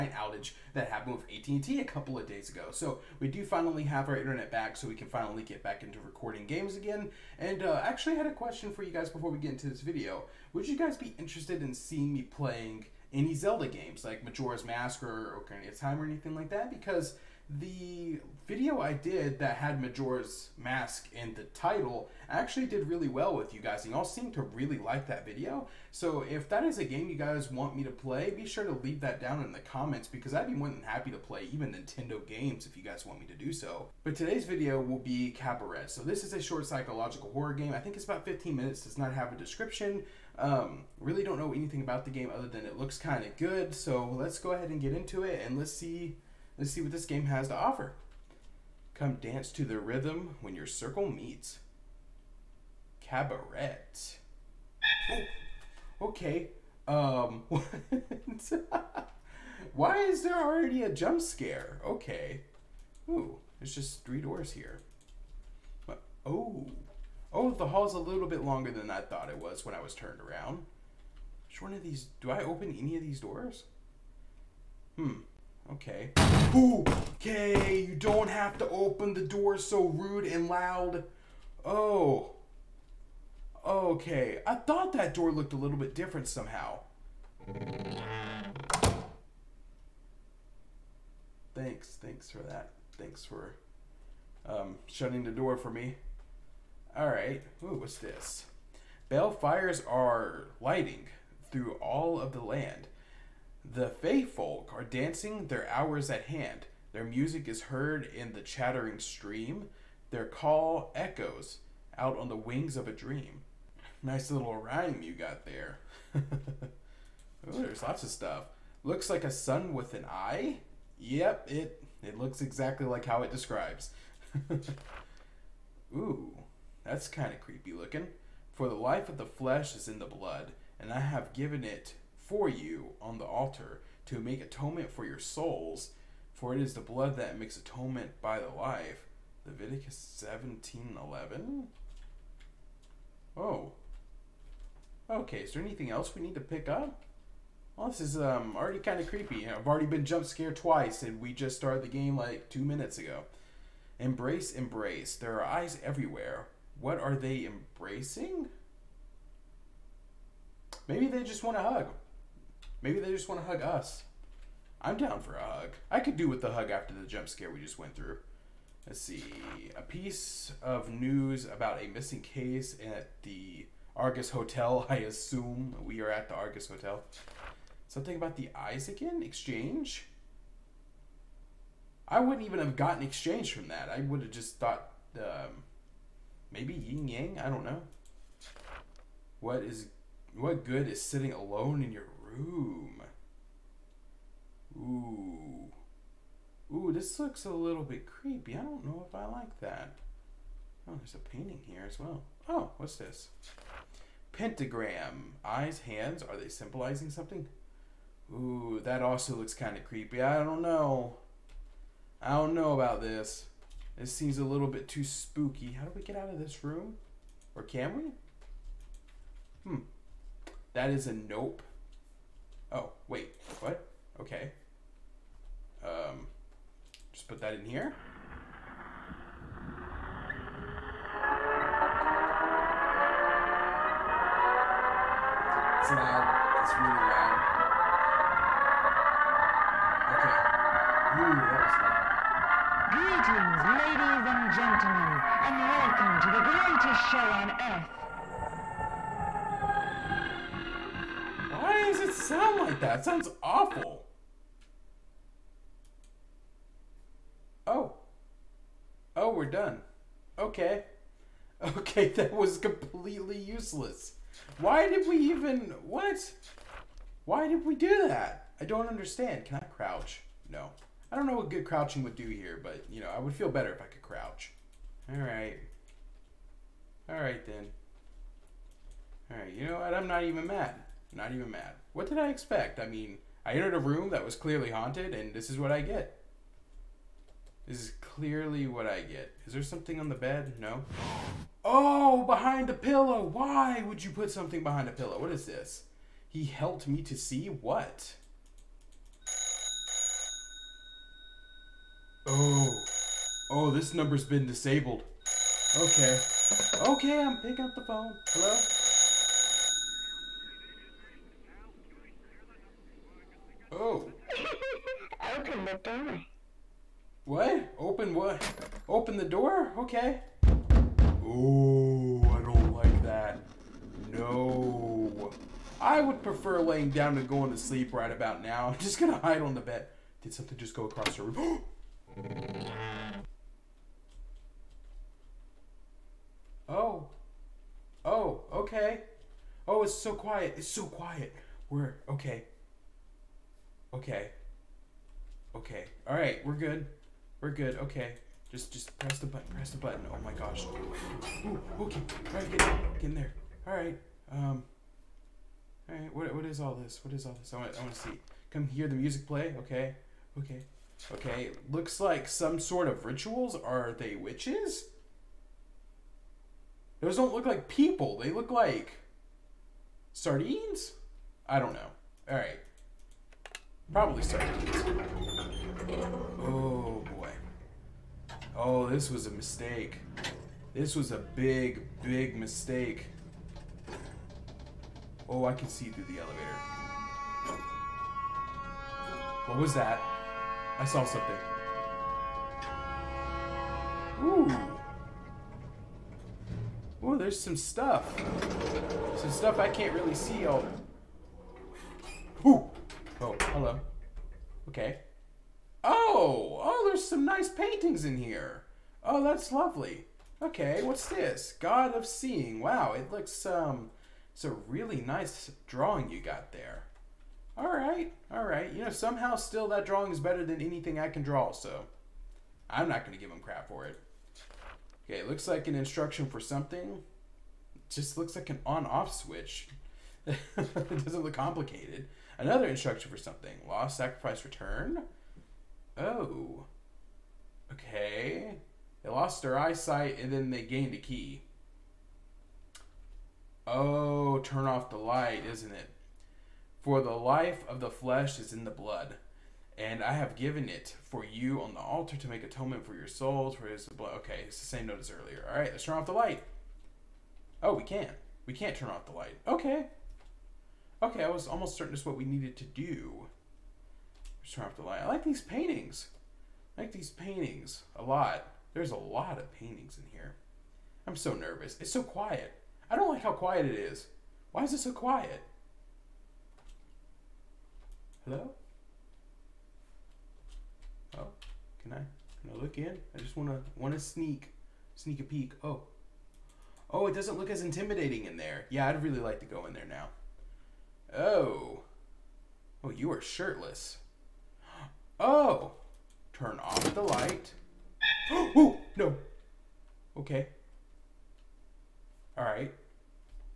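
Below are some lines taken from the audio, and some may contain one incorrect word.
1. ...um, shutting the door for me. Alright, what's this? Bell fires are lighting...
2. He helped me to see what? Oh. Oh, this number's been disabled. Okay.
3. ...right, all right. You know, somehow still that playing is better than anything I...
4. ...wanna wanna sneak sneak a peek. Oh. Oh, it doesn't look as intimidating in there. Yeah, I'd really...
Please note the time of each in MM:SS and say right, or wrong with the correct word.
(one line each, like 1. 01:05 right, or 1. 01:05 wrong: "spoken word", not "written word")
1. 01:34 right
2. 04:56 right
3. 06:57 wrong: "drawing", not "playing"
4. 08:03 right.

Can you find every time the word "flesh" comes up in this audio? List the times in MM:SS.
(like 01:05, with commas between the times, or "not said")
02:09, 07:27.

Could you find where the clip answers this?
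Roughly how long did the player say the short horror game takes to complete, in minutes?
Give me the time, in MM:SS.
00:38.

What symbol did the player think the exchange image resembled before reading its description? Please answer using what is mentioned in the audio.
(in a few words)
yin yang.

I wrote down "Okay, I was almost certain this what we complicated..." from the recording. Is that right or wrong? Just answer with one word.
wrong.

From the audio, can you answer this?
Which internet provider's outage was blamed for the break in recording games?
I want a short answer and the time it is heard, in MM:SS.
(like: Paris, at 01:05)
AT&T, at 00:01.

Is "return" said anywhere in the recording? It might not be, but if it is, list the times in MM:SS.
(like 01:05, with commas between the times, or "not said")
07:14.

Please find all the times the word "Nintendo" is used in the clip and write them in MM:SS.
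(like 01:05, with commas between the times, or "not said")
00:31.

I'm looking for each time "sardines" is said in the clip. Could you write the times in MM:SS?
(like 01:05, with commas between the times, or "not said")
06:10, 06:14.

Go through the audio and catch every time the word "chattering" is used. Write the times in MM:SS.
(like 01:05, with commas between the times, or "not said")
01:48.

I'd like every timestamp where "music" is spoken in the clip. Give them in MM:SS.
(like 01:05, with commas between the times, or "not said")
01:47, 05:58.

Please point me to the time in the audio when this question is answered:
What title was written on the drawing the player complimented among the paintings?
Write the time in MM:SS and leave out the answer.
06:51.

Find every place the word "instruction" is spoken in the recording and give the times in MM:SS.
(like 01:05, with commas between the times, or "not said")
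07:05, 07:12.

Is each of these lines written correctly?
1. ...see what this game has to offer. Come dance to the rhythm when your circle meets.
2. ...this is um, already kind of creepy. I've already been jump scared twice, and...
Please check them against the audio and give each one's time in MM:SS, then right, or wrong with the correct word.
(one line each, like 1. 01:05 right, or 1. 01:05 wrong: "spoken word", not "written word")
1. 00:46 right
2. 02:27 right.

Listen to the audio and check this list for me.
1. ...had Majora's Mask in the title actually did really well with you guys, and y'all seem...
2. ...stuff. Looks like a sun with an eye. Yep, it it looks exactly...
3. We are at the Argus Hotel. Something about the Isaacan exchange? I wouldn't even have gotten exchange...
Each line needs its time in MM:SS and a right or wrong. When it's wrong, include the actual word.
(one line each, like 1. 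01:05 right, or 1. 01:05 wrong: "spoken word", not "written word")
1. 00:19 right
2. 01:58 right
3. 02:55 right.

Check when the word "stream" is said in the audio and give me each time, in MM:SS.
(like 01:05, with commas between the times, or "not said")
01:48.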